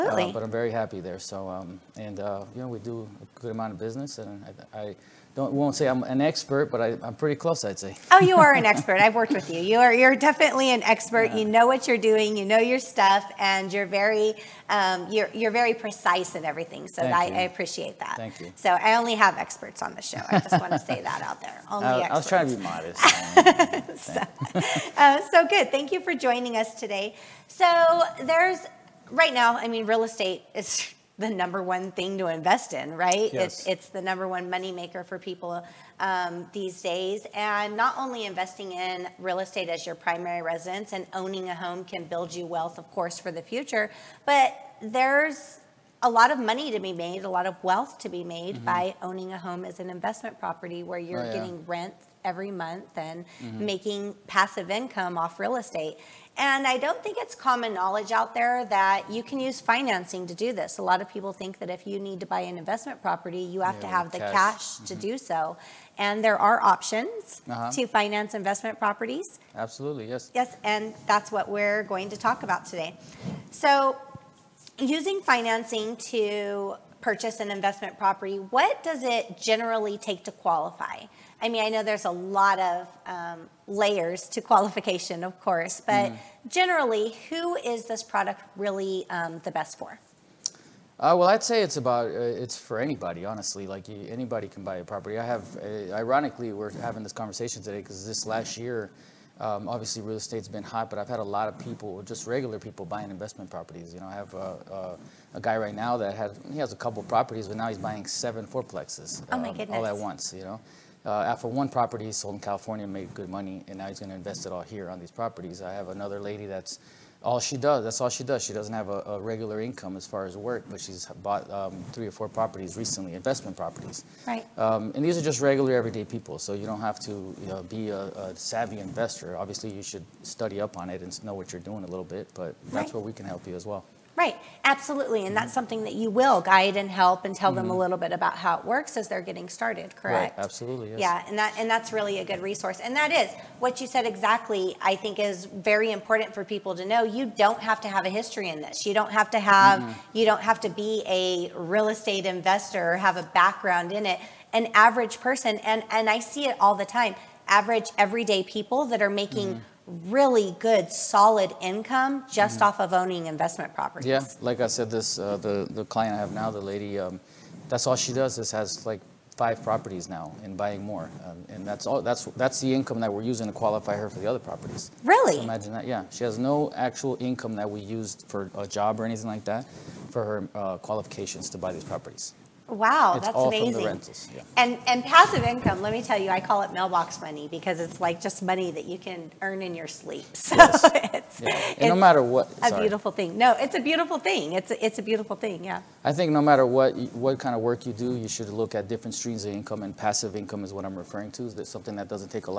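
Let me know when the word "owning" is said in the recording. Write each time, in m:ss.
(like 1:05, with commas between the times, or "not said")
0:41, 0:49, 2:42.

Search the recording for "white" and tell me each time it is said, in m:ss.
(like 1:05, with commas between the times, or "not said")
not said.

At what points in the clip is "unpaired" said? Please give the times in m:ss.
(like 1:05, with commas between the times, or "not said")
not said.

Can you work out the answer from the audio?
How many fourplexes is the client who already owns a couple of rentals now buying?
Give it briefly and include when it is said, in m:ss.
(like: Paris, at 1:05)
7, at 1:48.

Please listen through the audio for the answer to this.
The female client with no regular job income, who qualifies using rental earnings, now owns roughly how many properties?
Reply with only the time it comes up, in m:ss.
2:49.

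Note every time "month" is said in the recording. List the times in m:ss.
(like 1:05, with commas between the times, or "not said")
0:52.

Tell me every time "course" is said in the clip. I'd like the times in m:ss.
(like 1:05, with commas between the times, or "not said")
0:42, 1:25.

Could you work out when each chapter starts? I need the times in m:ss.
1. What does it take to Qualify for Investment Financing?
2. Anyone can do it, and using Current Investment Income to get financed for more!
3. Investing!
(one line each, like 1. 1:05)
1. 1:19
2. 2:34
3. 0:34.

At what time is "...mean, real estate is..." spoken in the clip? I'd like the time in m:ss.
0:29.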